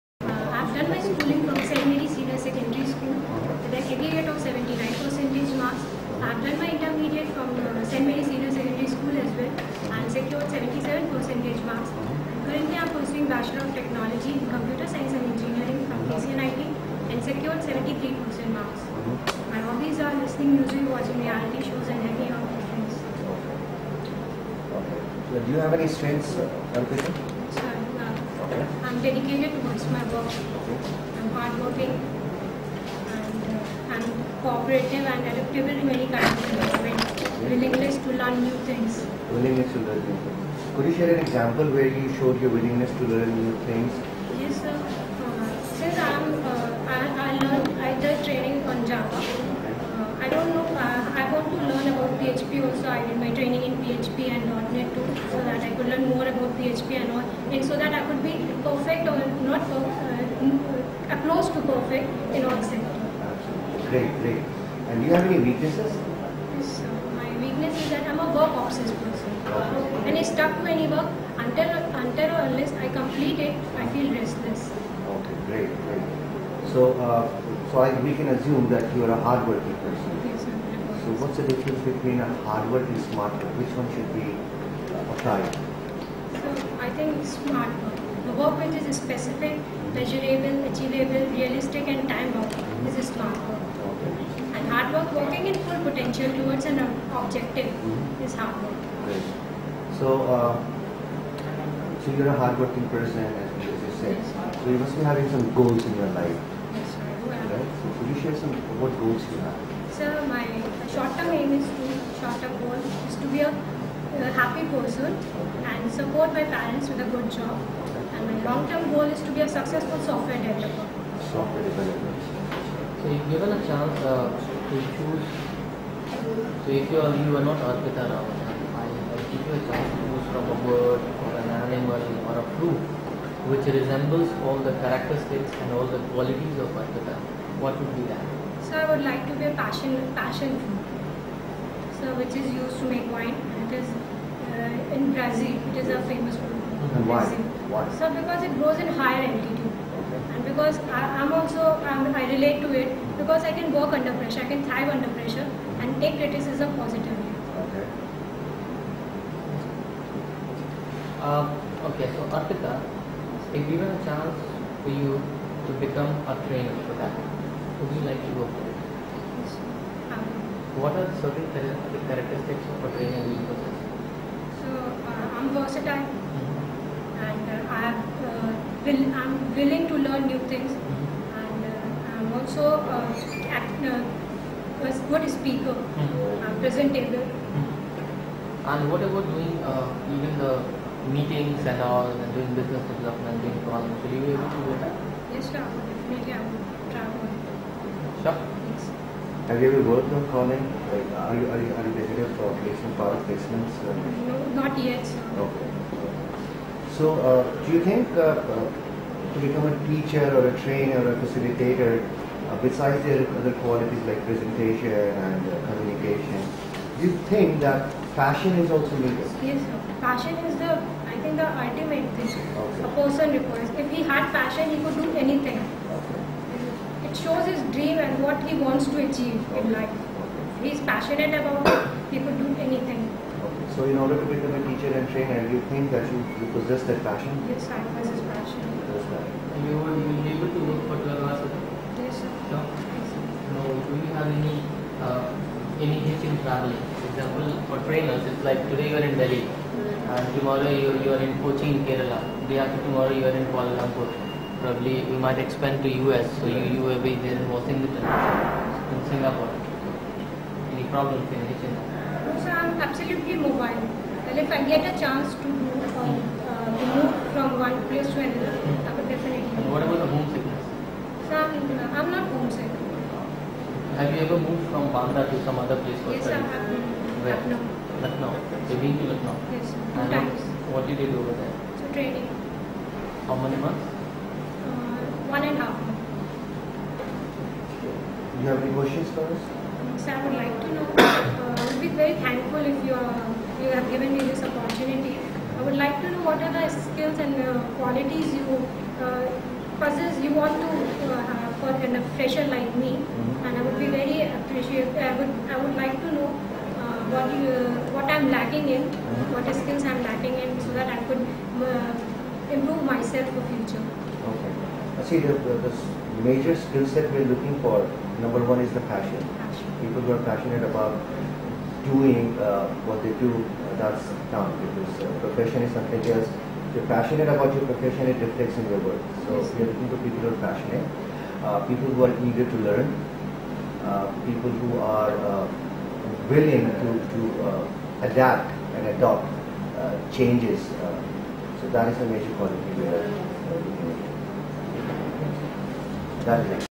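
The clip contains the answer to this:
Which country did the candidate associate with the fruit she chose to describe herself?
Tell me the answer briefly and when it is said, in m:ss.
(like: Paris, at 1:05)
Brazil, at 2:25.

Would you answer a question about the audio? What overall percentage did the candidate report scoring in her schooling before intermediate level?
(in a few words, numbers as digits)
79.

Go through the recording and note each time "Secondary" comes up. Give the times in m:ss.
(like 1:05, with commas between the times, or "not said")
0:02, 0:08.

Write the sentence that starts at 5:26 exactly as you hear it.
If you're passionate about your profession, it reflects in your work.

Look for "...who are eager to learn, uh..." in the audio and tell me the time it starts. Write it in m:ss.
5:31.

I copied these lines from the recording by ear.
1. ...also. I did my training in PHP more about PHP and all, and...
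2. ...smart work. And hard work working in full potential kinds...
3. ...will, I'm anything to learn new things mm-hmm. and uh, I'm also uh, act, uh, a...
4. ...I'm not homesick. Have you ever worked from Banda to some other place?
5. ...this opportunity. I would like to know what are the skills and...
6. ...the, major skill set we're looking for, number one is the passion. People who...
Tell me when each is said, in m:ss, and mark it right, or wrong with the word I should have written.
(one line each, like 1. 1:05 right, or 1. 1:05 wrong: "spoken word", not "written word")
1. 0:52 right
2. 1:33 wrong: "towards", not "kinds"
3. 2:58 wrong: "willing", not "anything"
4. 4:31 wrong: "moved", not "worked"
5. 4:54 right
6. 5:15 right.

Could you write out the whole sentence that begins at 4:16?
you, you will be there in Washington, in Singapore.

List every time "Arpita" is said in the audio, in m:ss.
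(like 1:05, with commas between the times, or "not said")
0:26, 2:07, 2:16.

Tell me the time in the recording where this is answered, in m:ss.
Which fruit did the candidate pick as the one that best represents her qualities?
2:20.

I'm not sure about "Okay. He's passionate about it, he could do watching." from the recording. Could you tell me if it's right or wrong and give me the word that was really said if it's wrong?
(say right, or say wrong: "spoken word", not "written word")
wrong: "anything", not "watching".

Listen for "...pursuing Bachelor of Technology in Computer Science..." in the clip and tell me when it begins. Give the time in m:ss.
0:12.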